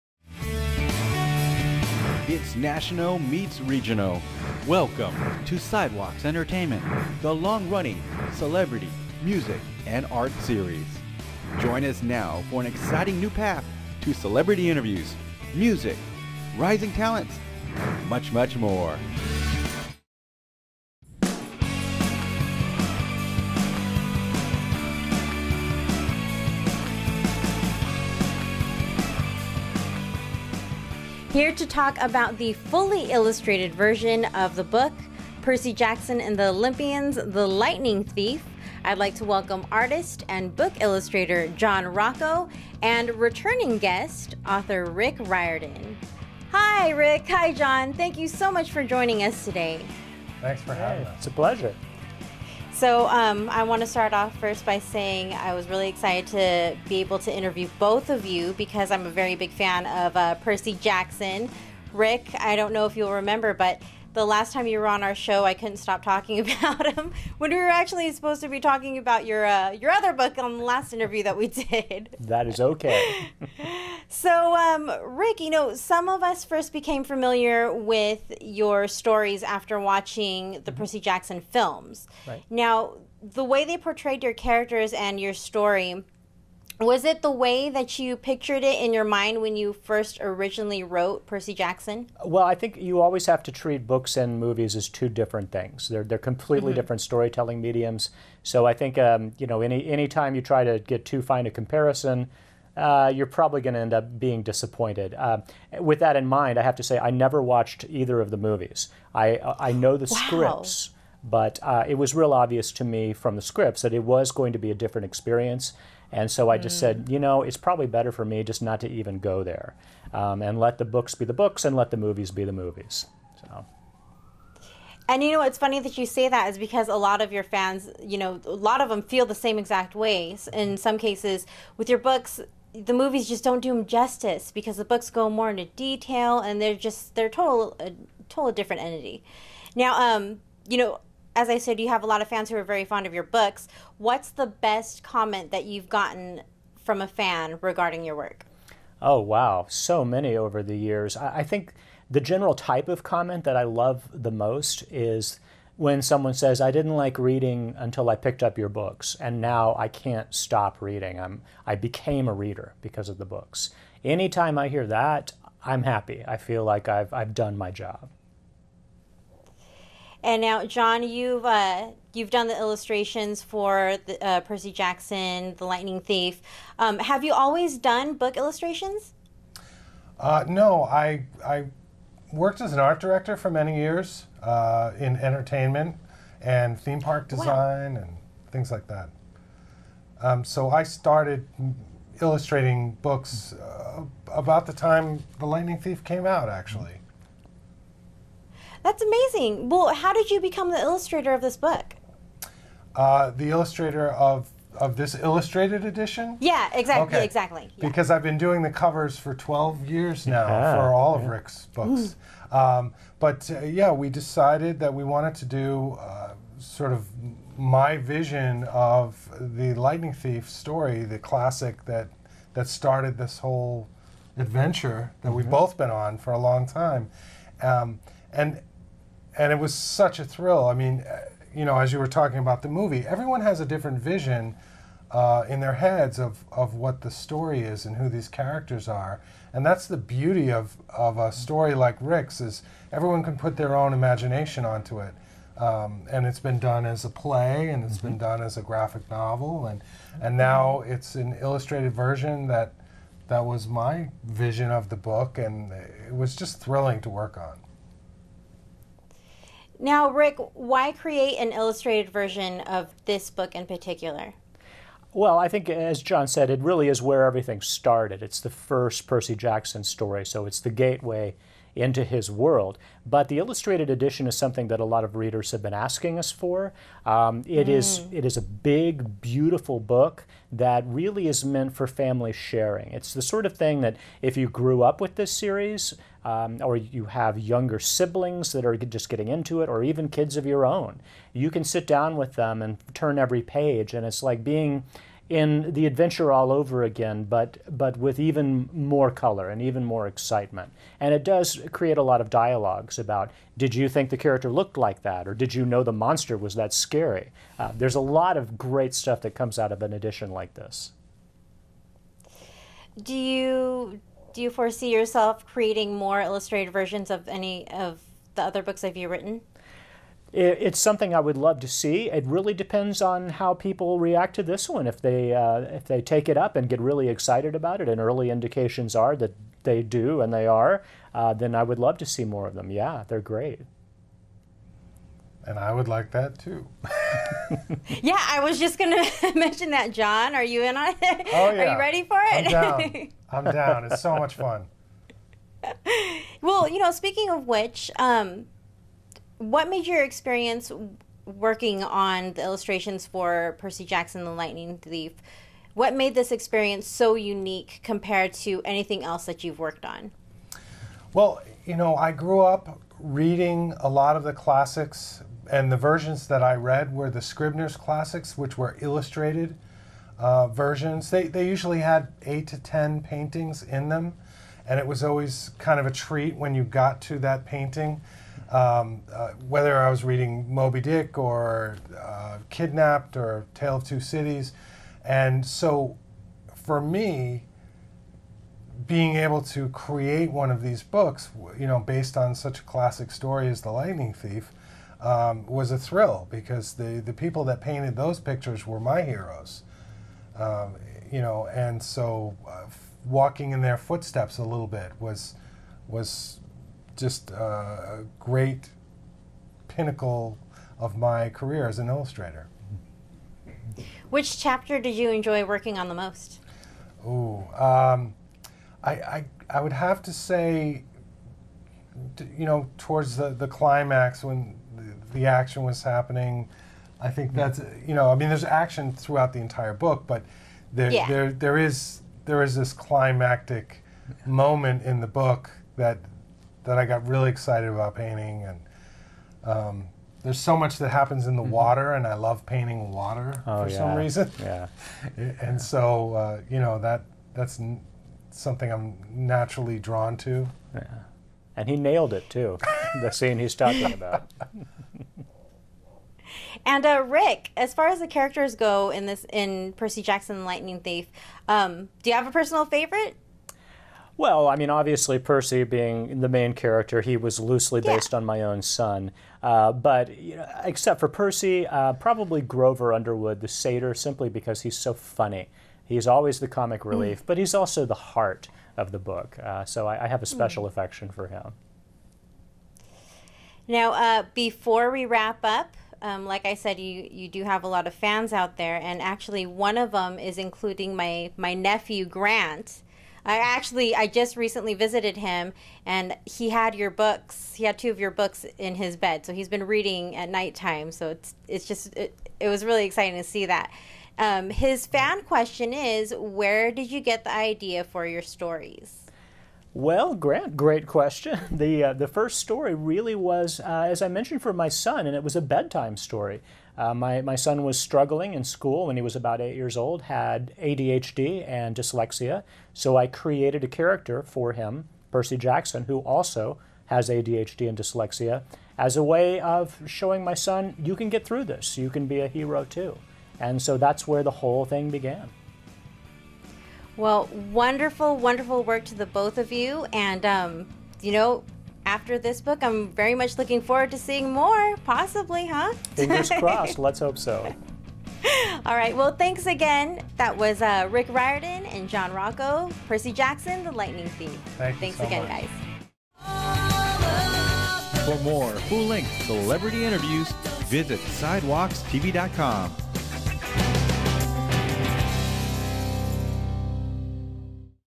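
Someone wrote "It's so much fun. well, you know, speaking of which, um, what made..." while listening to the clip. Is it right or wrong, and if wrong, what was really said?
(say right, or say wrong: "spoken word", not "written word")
right.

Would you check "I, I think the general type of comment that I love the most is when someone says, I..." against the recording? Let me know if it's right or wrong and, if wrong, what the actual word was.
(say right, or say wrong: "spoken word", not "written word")
right.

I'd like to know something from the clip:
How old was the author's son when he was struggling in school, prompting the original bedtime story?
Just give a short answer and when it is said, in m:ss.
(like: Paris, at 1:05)
8, at 8:39.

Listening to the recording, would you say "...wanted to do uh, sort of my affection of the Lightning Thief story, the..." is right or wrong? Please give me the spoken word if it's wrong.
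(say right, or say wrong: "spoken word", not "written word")
wrong: "vision", not "affection".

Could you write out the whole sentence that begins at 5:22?
It really depends on how people react to this one.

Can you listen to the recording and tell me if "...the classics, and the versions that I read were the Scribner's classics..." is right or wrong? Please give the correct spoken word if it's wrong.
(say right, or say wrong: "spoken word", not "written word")
right.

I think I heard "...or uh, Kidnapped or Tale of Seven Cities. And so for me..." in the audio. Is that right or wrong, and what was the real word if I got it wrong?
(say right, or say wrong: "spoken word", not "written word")
wrong: "Two", not "Seven".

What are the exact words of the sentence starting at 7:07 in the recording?
that's, you know, I mean, there's action throughout the entire book, but there, yeah.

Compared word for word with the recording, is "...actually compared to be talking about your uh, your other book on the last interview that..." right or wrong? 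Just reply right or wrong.
wrong.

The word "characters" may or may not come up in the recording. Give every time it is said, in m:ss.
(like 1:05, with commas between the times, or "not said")
1:24, 3:58, 5:04, 7:38, 7:46, 8:43.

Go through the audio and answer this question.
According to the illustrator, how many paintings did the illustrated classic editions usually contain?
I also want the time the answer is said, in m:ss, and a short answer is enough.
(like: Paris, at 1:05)
8 to 10, at 6:12.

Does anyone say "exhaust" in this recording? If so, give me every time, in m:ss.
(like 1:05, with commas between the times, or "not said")
not said.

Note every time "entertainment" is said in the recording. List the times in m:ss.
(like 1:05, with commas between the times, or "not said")
0:06, 3:05.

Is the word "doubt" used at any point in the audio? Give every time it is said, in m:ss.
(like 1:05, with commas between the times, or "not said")
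not said.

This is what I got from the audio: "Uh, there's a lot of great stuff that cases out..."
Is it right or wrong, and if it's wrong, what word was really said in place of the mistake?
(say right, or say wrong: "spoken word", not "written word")
wrong: "comes", not "cases".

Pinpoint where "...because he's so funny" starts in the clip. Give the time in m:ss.
7:54.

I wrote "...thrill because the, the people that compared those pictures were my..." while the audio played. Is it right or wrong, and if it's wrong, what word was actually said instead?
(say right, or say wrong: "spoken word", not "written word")
wrong: "painted", not "compared".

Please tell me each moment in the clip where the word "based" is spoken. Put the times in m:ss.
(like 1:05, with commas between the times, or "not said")
6:31, 7:47.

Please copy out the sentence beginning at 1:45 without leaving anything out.
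Uh, with that in mind, I have to say I never watched either of the movies.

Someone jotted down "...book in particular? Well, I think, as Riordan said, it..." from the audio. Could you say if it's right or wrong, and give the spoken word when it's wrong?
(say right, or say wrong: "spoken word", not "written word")
wrong: "John", not "Riordan".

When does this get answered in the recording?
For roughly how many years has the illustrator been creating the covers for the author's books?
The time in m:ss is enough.
3:29.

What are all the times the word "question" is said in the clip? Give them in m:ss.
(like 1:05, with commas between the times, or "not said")
8:25, 8:30.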